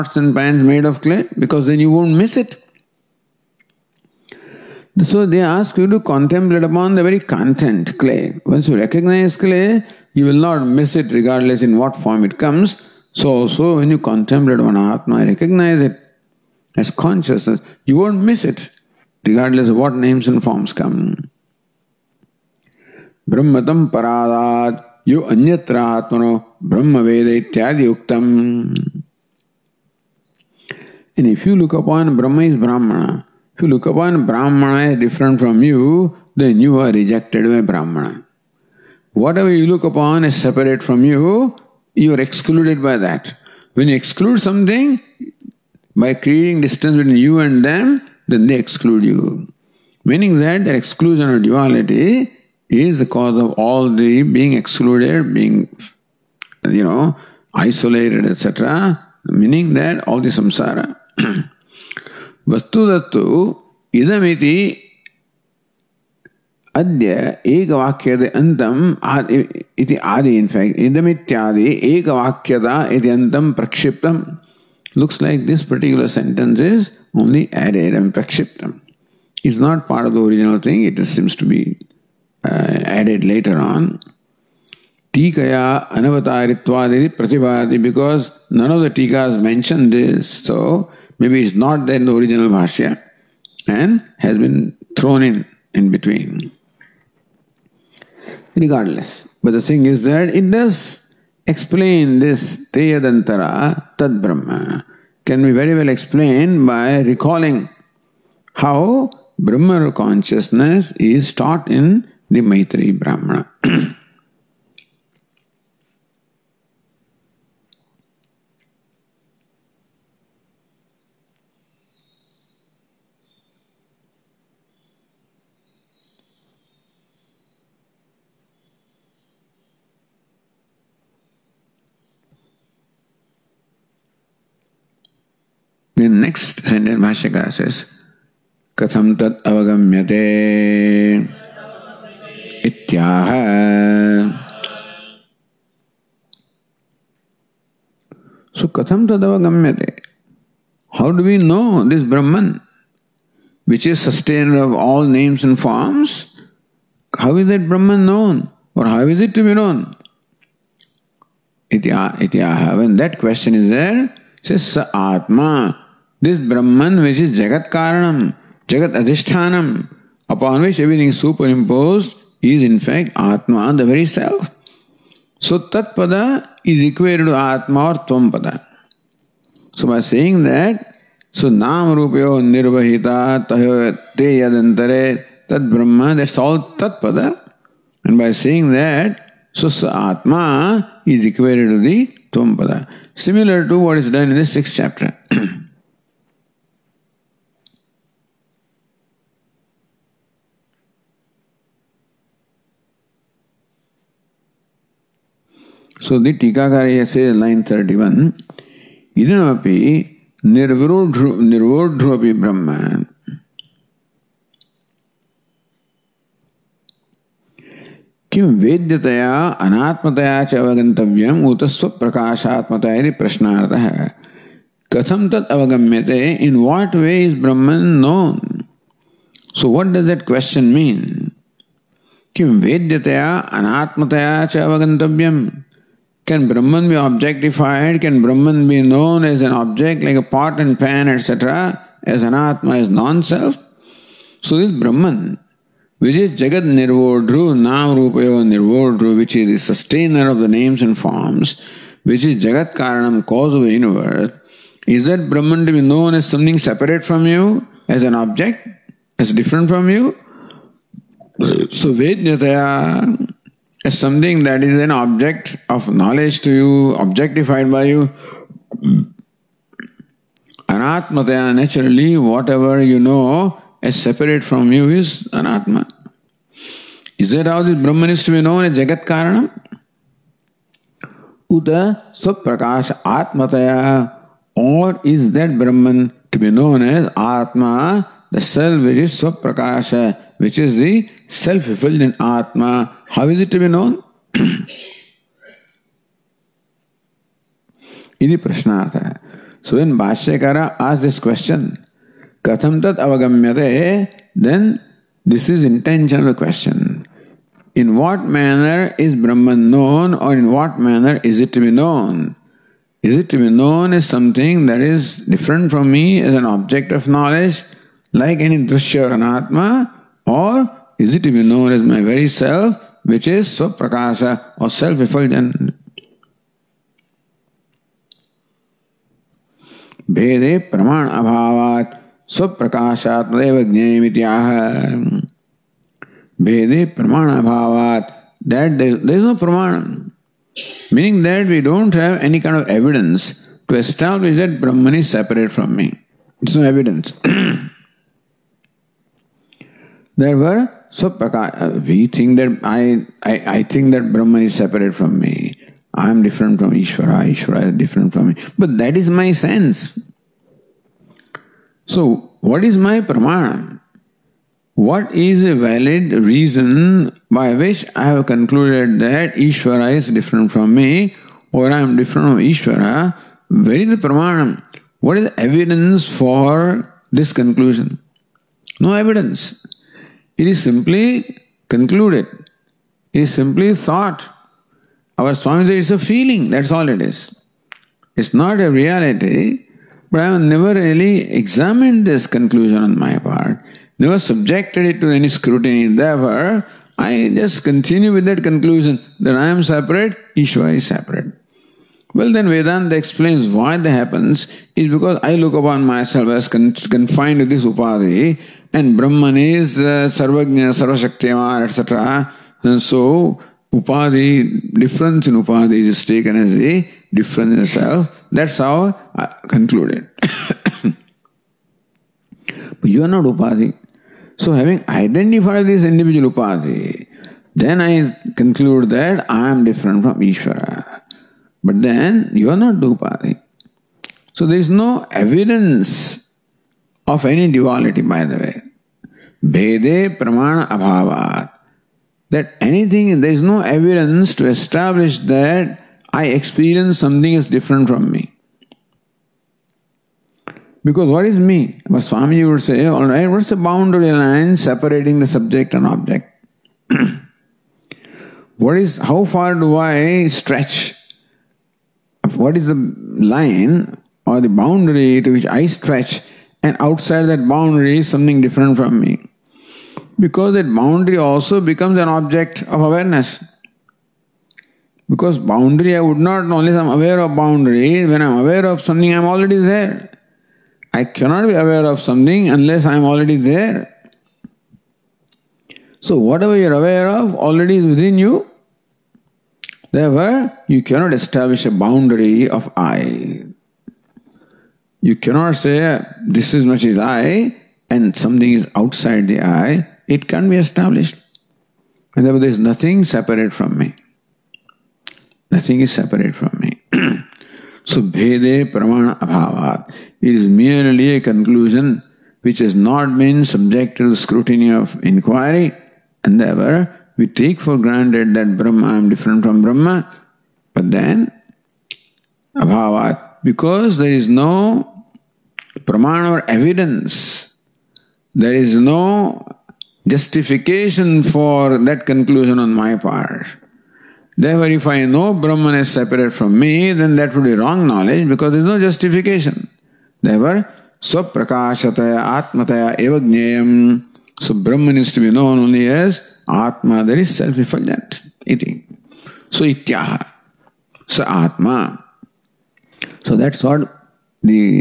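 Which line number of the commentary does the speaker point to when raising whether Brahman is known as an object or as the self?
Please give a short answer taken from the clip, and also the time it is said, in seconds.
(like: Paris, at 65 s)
31, at 207 s.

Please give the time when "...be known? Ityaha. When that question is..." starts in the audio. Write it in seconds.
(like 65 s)
159 s.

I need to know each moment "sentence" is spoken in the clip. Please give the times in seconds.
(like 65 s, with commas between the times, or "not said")
76 s, 136 s.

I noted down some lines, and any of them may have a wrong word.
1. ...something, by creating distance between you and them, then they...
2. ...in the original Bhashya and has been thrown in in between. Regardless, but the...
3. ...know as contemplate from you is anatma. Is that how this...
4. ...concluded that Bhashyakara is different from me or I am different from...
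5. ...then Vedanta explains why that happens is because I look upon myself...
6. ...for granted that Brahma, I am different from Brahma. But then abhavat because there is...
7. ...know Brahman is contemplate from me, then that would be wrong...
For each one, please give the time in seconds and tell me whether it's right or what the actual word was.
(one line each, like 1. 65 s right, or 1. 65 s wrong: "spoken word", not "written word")
1. 44 s right
2. 91 s right
3. 272 s wrong: "separate", not "contemplate"
4. 368 s wrong: "Ishvara", not "Bhashyakara"
5. 402 s right
6. 517 s right
7. 535 s wrong: "separate", not "contemplate".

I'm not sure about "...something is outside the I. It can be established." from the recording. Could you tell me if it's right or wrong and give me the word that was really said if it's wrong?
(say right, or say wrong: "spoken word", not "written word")
right.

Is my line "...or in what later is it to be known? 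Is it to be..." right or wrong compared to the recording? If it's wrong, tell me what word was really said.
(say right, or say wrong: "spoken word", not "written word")
wrong: "manner", not "later".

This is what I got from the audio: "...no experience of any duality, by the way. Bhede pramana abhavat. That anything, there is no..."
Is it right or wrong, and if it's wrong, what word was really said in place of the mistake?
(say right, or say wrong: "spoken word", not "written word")
wrong: "evidence", not "experience".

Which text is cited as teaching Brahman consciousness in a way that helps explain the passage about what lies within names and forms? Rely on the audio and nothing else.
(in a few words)
Maitri Brahmana.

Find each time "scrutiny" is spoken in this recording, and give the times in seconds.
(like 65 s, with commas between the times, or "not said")
395 s, 514 s.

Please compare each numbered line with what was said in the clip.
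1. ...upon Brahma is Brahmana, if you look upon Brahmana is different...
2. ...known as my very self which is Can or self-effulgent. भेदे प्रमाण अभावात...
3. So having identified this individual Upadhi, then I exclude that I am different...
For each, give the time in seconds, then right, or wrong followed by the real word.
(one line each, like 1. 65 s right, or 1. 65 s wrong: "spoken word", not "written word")
1. 31 s right
2. 321 s wrong: "Svaprakasha", not "Can"
3. 424 s wrong: "conclude", not "exclude".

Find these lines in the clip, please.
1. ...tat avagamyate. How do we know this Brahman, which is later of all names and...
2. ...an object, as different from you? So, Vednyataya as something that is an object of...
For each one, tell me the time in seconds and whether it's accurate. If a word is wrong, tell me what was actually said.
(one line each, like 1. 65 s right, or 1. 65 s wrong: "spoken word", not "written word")
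1. 149 s wrong: "sustainer", not "later"
2. 258 s right.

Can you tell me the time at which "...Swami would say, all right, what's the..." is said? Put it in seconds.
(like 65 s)
452 s.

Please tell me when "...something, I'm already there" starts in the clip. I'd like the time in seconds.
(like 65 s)
478 s.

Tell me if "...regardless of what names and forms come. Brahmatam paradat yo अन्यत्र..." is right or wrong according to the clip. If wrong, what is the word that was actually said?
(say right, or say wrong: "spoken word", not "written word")
right.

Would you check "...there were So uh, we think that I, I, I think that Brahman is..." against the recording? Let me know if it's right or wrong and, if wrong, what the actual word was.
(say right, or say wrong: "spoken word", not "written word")
right.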